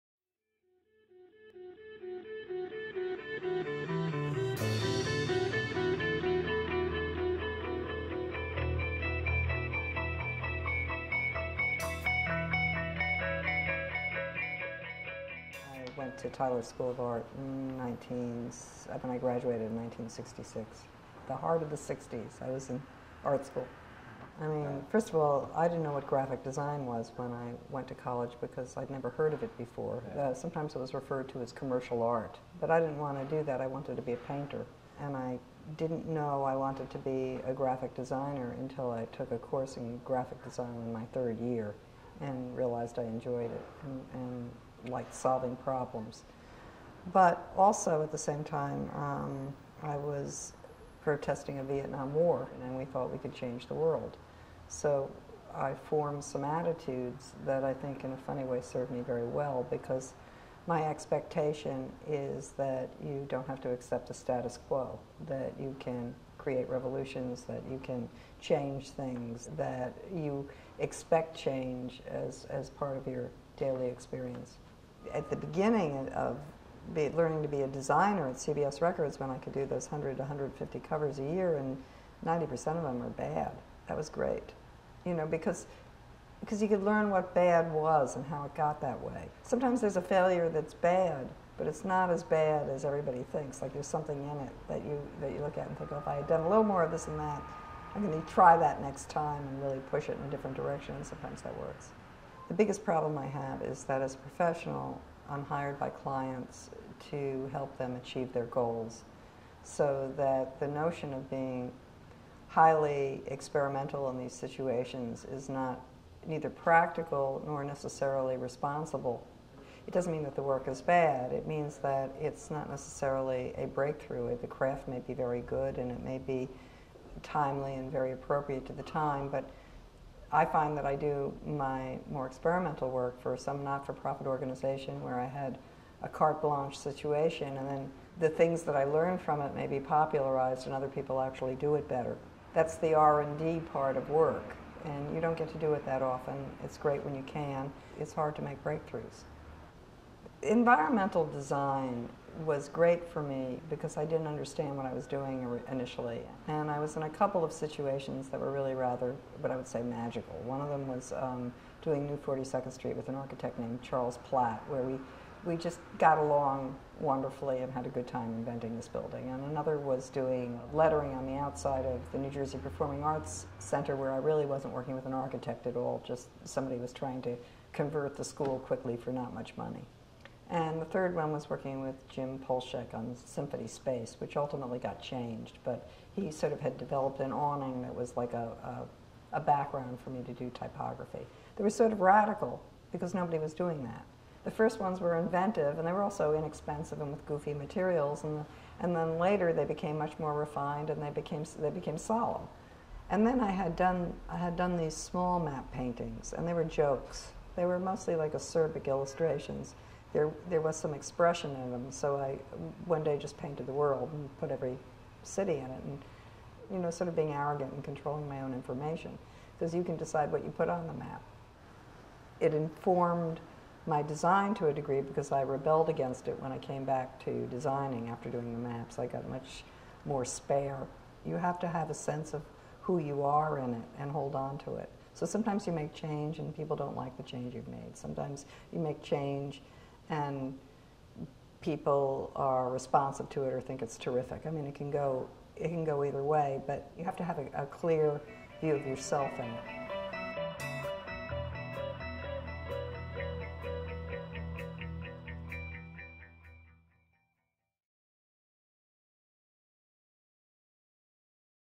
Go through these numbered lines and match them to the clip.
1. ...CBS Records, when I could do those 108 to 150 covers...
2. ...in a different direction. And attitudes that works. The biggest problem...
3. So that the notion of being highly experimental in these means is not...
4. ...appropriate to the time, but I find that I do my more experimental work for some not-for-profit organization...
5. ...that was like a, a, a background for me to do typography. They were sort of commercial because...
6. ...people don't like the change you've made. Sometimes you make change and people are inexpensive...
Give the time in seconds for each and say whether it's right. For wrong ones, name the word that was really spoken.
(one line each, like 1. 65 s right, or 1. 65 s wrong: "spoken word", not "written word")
1. 78 s wrong: "100", not "108"
2. 100 s wrong: "sometimes", not "attitudes"
3. 109 s wrong: "situations", not "means"
4. 128 s right
5. 187 s wrong: "radical", not "commercial"
6. 236 s wrong: "responsive", not "inexpensive".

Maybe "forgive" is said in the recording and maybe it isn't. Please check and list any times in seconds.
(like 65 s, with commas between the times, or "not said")
not said.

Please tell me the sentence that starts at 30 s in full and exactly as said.
Uh, sometimes it was referred to as commercial art, but I didn't want to do that.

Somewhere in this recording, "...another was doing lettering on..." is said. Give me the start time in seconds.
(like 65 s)
169 s.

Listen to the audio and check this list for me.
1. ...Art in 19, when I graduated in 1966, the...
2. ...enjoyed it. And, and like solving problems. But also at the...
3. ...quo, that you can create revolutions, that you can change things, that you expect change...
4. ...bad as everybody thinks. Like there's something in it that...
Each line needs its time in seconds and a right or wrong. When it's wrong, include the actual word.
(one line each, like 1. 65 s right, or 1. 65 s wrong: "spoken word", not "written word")
1. 16 s right
2. 43 s right
3. 64 s right
4. 92 s right.